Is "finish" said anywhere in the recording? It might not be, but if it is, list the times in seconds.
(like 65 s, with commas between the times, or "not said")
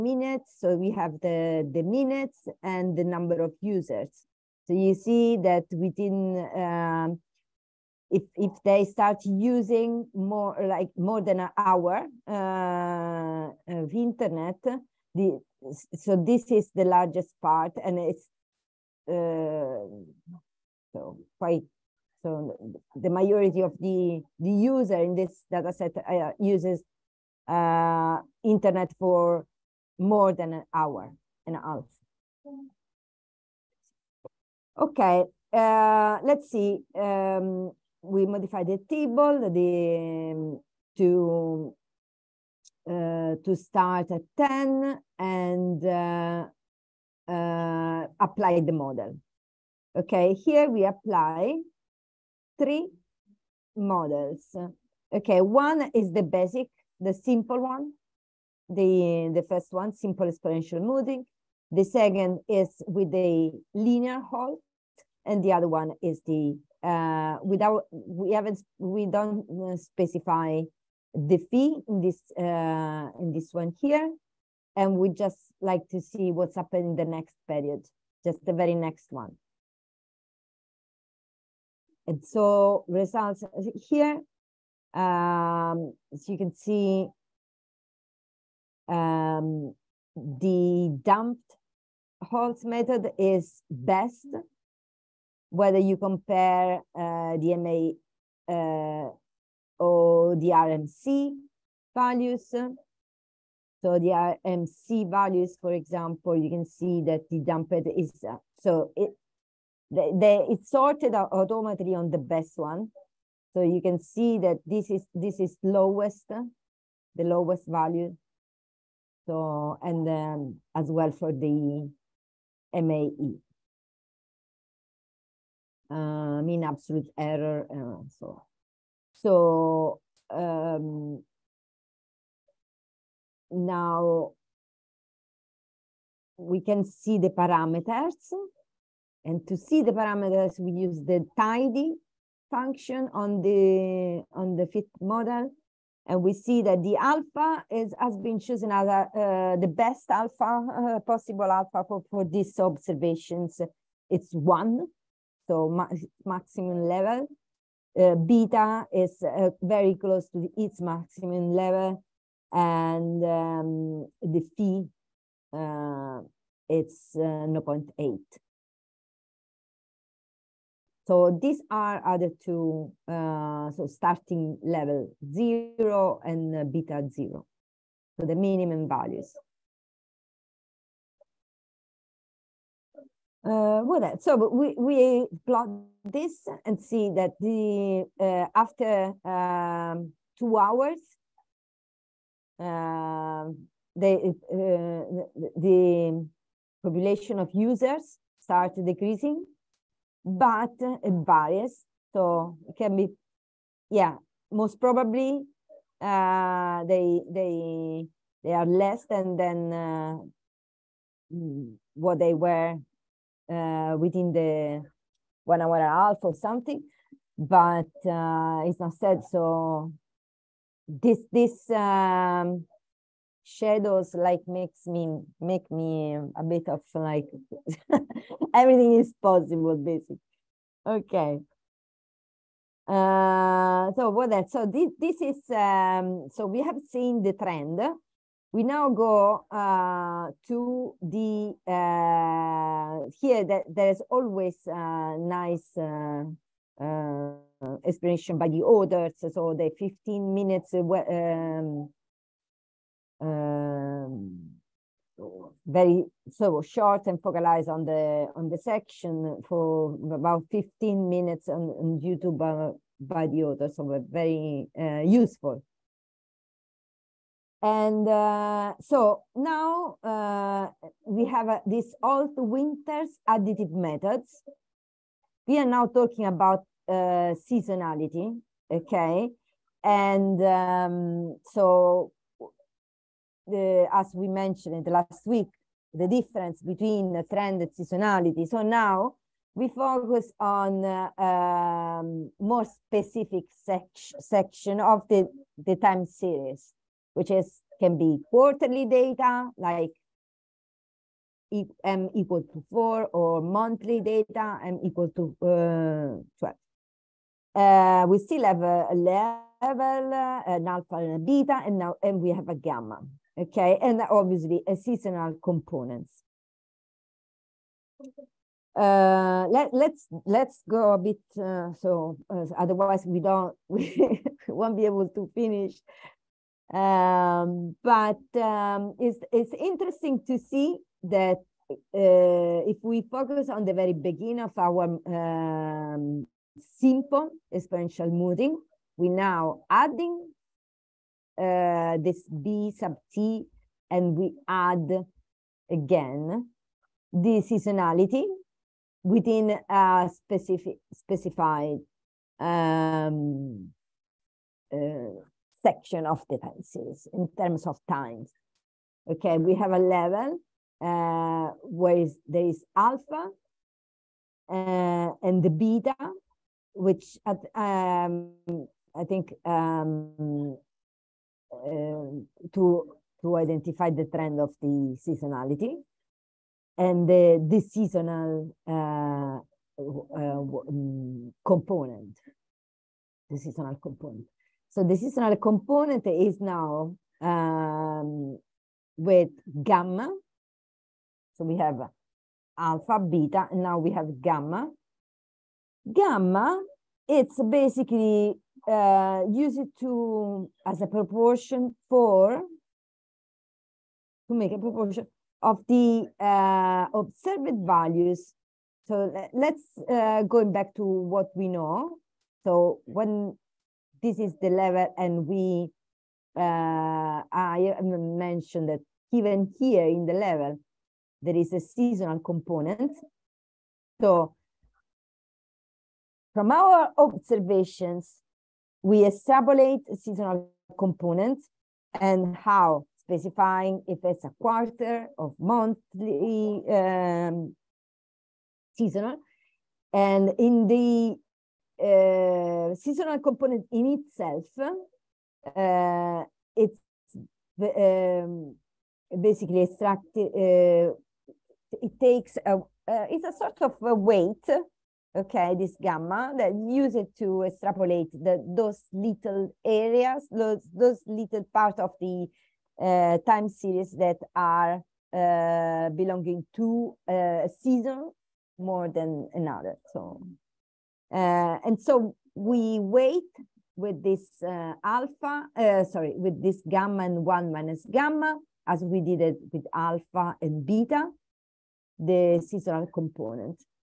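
325 s.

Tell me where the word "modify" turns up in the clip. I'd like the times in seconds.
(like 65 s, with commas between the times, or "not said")
38 s.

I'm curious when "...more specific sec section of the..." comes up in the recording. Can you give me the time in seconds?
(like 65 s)
292 s.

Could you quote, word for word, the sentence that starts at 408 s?
So let's uh, going back to what we know.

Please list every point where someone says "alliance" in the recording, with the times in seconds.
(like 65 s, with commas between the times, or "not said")
not said.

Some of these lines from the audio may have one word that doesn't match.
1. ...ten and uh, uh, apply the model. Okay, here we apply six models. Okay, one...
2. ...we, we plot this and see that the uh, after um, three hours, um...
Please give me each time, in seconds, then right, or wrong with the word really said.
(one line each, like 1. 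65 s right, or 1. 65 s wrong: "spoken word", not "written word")
1. 44 s wrong: "three", not "six"
2. 184 s wrong: "two", not "three".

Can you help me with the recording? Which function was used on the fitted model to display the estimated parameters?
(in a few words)
tidy.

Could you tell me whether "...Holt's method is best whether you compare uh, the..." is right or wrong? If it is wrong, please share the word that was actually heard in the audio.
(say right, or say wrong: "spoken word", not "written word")
right.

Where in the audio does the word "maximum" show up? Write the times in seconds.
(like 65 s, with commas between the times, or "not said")
156 s, 160 s.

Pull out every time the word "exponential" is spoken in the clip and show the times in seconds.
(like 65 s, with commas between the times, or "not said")
60 s, 337 s.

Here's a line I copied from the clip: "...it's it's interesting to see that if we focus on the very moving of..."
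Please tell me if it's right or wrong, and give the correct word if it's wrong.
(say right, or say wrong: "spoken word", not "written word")
wrong: "beginning", not "moving".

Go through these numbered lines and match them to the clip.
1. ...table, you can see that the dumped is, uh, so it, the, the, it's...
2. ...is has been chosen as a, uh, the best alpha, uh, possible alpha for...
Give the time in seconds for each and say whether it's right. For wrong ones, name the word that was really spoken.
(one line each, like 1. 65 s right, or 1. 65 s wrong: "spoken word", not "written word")
1. 105 s wrong: "example", not "table"
2. 147 s right.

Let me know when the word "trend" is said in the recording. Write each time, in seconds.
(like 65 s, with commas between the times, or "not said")
237 s, 287 s, 374 s.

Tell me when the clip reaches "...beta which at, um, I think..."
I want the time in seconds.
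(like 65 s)
365 s.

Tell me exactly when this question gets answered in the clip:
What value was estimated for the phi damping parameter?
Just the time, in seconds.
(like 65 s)
167 s.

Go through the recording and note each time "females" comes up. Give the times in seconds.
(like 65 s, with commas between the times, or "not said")
not said.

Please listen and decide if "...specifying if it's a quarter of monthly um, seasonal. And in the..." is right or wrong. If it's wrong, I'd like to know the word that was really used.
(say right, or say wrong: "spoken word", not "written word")
right.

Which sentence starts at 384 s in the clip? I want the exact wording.
So the seasonal component is now um, with gamma.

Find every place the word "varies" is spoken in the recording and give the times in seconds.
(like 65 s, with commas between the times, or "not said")
201 s.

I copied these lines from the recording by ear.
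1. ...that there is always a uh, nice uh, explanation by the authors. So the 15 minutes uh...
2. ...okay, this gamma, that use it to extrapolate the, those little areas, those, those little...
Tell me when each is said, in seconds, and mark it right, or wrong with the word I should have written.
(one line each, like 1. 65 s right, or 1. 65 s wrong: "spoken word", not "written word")
1. 243 s right
2. 455 s right.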